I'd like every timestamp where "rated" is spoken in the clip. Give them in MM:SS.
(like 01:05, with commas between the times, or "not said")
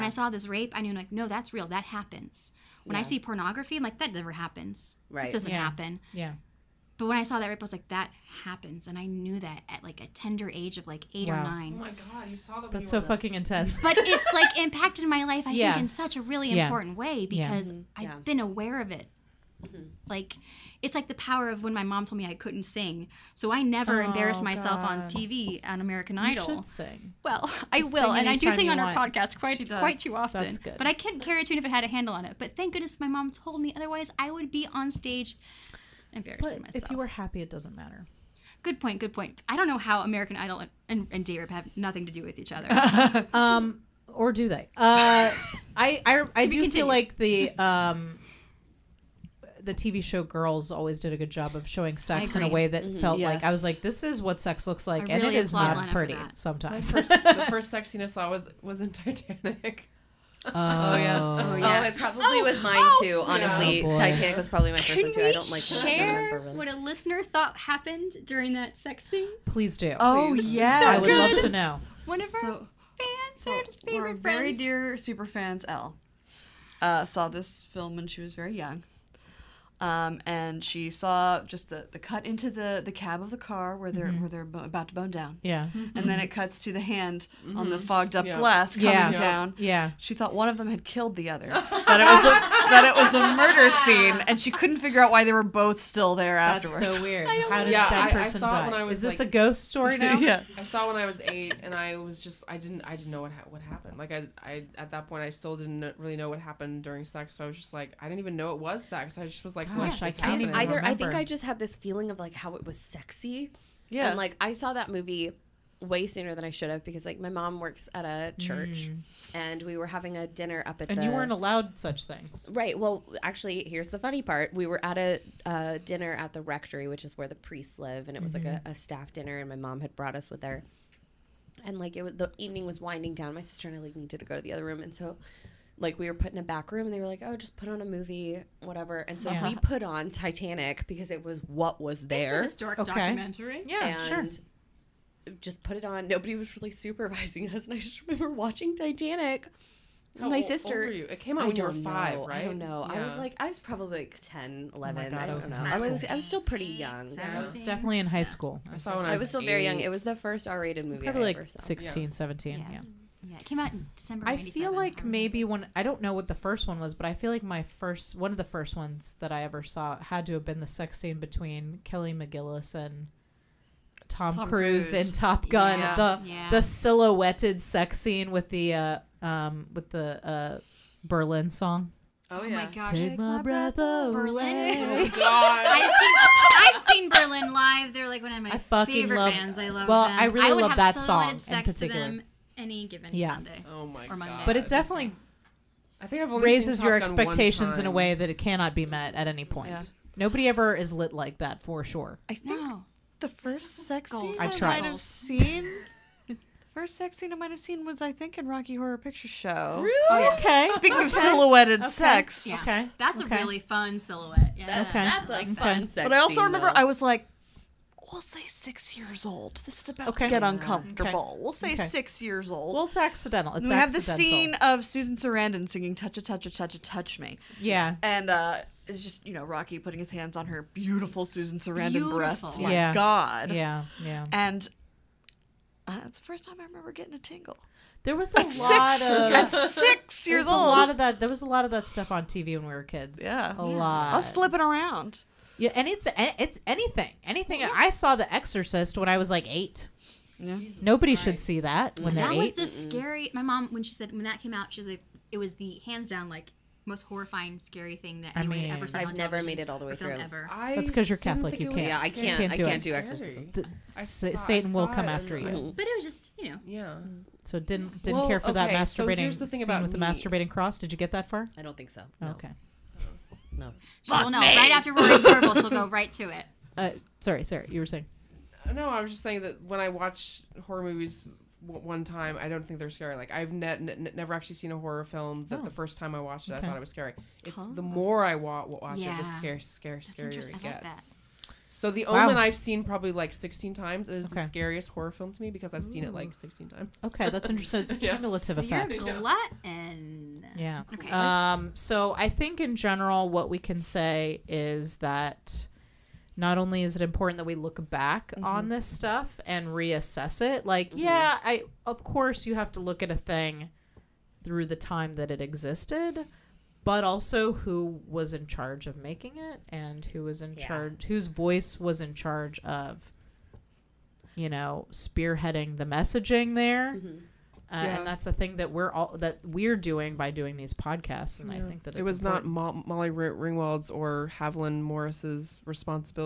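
02:40.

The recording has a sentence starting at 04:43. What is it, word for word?
Like I've ne- ne- never actually seen a horror film that oh.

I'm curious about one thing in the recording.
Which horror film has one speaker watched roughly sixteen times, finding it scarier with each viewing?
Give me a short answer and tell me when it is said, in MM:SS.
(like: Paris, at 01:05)
The Omen, at 04:51.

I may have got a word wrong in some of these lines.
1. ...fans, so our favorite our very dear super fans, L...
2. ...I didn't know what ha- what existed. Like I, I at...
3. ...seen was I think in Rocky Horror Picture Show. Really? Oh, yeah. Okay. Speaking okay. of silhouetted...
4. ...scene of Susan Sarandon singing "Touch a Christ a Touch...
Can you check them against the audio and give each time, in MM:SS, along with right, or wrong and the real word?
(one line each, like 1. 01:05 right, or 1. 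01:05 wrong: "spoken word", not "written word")
1. 01:12 right
2. 01:42 wrong: "happened", not "existed"
3. 03:27 right
4. 03:44 wrong: "Touch", not "Christ".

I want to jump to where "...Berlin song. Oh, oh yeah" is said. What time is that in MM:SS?
03:01.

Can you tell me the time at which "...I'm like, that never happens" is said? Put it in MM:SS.
00:03.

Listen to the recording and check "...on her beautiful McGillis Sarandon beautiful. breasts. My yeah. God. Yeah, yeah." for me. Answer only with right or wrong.
wrong.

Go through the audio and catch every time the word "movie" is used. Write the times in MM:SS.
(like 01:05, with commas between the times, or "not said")
01:54, 02:17, 02:40, 04:40.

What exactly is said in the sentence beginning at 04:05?
Yeah, and it's it's anything, anything.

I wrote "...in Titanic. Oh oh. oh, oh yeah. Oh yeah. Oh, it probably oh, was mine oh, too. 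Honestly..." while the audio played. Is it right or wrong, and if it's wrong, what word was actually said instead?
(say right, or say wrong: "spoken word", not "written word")
right.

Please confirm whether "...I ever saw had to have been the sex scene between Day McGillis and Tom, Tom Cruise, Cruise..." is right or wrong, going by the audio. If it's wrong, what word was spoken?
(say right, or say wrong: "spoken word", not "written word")
wrong: "Kelly", not "Day".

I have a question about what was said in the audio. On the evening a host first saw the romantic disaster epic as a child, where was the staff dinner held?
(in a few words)
The rectory.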